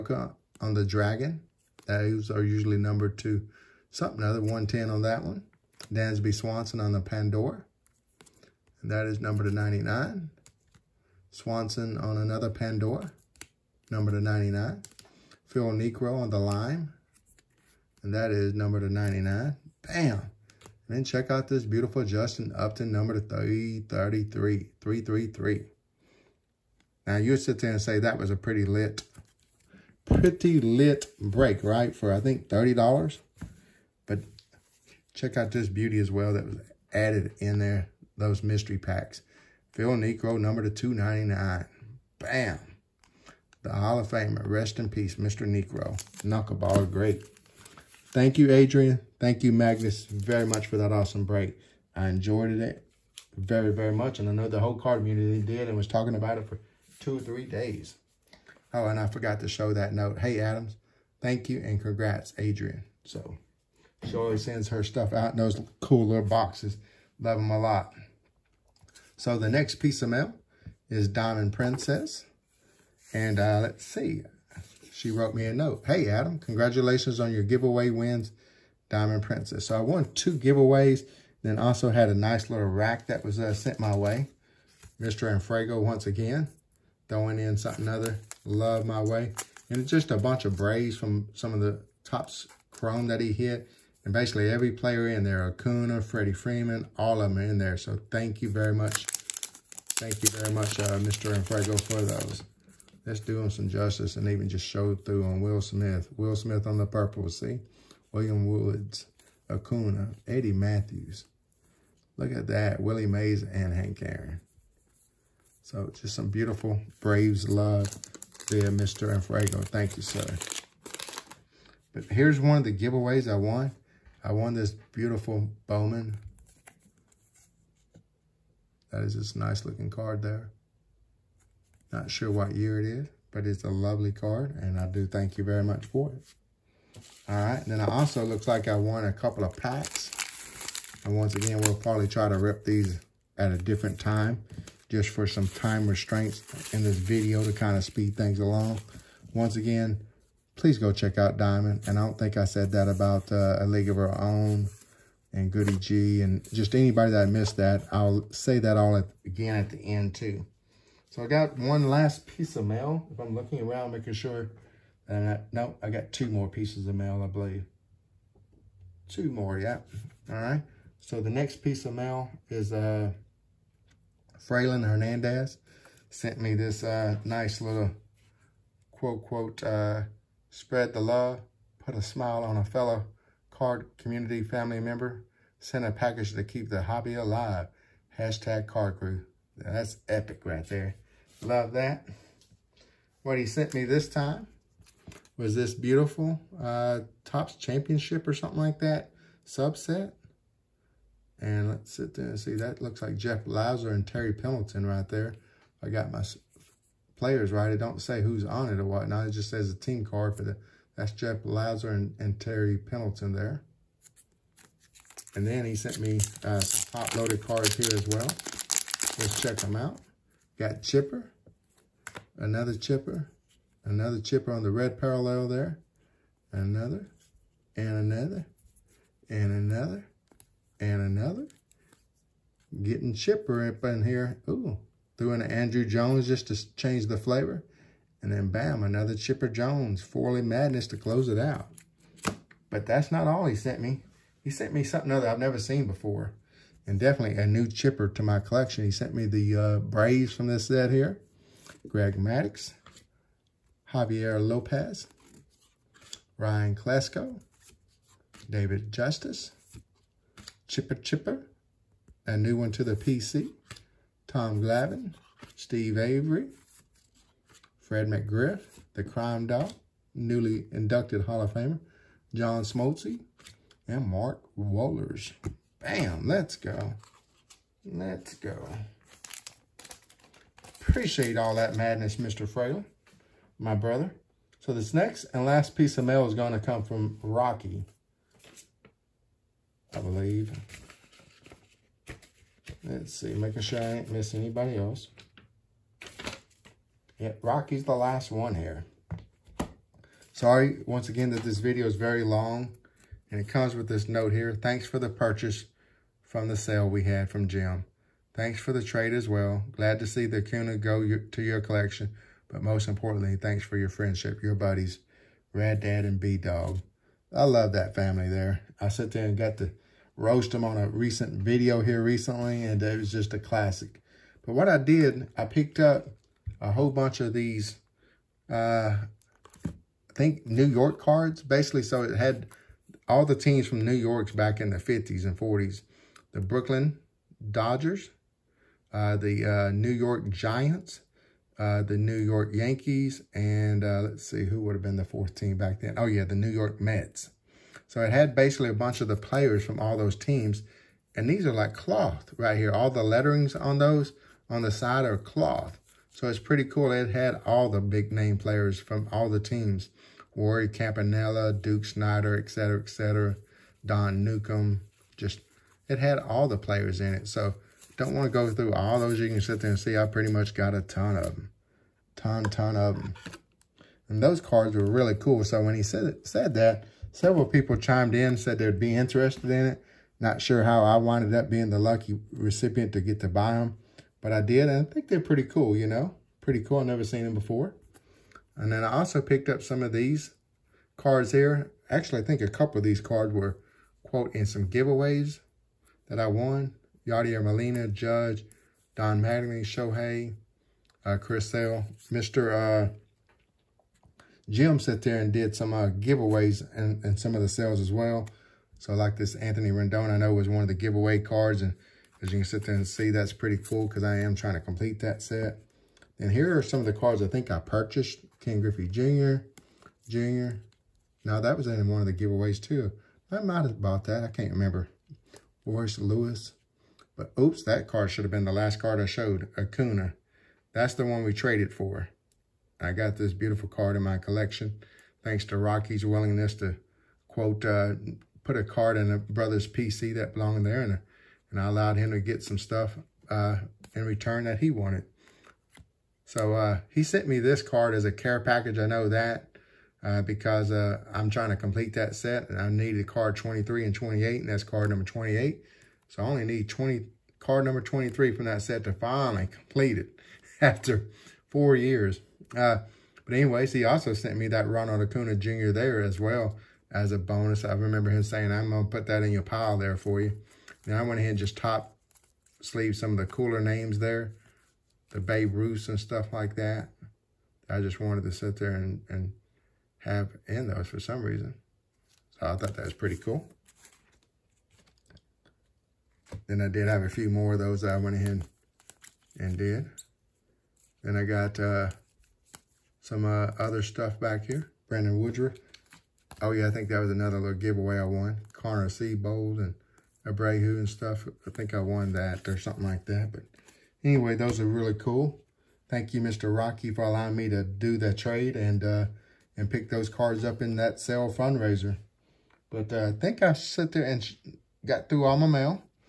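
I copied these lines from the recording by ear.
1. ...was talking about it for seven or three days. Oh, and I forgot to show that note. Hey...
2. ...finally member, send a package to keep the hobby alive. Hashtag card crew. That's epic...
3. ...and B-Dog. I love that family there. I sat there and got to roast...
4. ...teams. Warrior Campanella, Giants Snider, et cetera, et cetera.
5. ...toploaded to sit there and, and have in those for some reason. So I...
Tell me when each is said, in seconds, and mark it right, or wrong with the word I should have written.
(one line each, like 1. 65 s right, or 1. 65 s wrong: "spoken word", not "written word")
1. 55 s wrong: "two", not "seven"
2. 184 s wrong: "family", not "finally"
3. 316 s right
4. 359 s wrong: "Duke", not "Giants"
5. 478 s wrong: "wanted", not "toploaded".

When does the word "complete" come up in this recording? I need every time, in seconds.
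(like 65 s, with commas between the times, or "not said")
414 s, 451 s, 459 s.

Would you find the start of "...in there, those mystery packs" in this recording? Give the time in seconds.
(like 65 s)
37 s.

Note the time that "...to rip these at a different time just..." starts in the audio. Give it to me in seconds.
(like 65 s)
142 s.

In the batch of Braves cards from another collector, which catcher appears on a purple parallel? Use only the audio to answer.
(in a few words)
Will Smith.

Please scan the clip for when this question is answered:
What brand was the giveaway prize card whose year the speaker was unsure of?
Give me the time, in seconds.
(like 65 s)
125 s.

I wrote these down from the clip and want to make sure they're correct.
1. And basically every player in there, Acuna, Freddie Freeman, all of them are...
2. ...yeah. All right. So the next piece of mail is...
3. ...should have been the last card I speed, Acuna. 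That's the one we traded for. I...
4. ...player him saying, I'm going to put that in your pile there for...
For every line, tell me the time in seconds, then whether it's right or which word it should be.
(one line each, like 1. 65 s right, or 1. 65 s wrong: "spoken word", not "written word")
1. 94 s right
2. 169 s right
3. 428 s wrong: "showed", not "speed"
4. 467 s wrong: "remember", not "player".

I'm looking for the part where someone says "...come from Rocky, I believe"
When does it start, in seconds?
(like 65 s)
286 s.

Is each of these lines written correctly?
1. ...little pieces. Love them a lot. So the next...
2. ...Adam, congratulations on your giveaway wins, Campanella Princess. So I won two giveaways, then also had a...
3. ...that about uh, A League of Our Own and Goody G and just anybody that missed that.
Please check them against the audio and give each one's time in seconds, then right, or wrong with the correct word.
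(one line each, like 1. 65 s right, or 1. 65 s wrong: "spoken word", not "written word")
1. 66 s wrong: "boxes", not "pieces"
2. 76 s wrong: "Diamond", not "Campanella"
3. 152 s right.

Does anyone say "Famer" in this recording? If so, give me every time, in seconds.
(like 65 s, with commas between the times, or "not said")
44 s, 271 s.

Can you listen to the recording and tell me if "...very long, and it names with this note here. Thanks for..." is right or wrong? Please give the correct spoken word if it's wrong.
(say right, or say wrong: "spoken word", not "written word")
wrong: "comes", not "names".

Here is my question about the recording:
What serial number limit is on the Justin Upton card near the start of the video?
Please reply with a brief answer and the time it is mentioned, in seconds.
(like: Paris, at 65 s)
333, at 22 s.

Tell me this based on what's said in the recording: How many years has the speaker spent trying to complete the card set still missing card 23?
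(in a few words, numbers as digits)
4.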